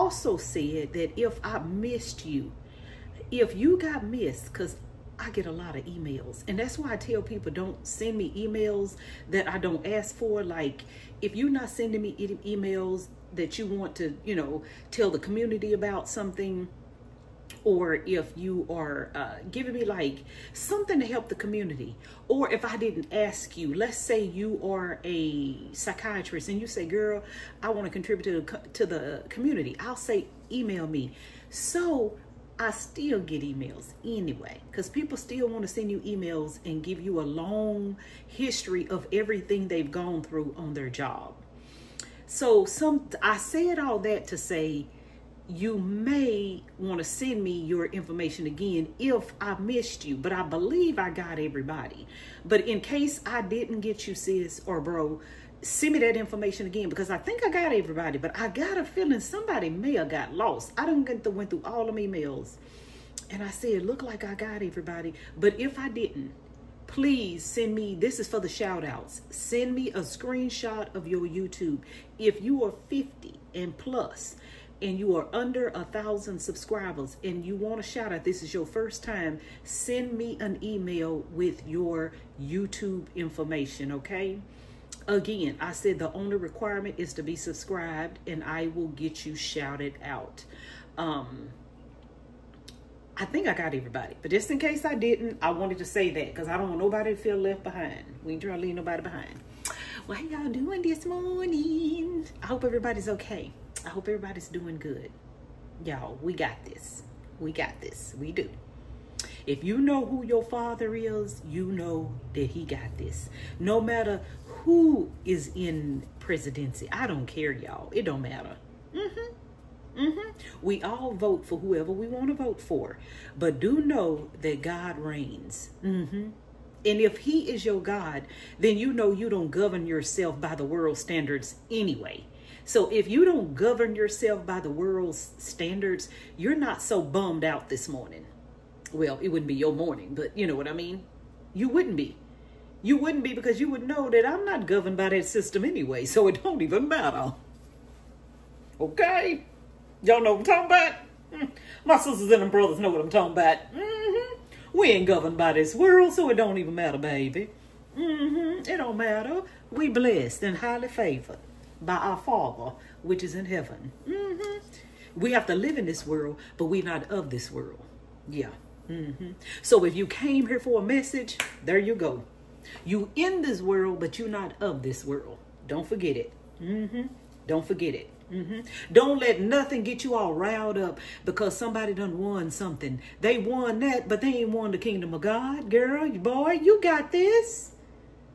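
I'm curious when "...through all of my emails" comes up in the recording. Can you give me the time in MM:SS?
01:01.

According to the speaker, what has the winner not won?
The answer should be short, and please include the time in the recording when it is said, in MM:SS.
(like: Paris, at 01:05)
The kingdom of God, at 03:04.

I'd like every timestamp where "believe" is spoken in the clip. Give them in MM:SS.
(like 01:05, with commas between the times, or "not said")
00:50.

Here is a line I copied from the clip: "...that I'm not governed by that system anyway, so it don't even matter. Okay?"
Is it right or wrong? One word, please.
right.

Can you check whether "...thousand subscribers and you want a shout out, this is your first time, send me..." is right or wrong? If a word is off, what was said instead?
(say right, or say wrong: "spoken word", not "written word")
right.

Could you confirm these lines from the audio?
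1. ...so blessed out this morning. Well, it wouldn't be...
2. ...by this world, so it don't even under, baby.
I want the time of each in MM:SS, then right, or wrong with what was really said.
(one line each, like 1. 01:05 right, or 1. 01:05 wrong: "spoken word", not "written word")
1. 02:16 wrong: "bummed", not "blessed"
2. 02:35 wrong: "matter", not "under".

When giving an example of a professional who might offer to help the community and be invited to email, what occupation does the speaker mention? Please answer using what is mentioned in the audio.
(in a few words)
Psychiatrist.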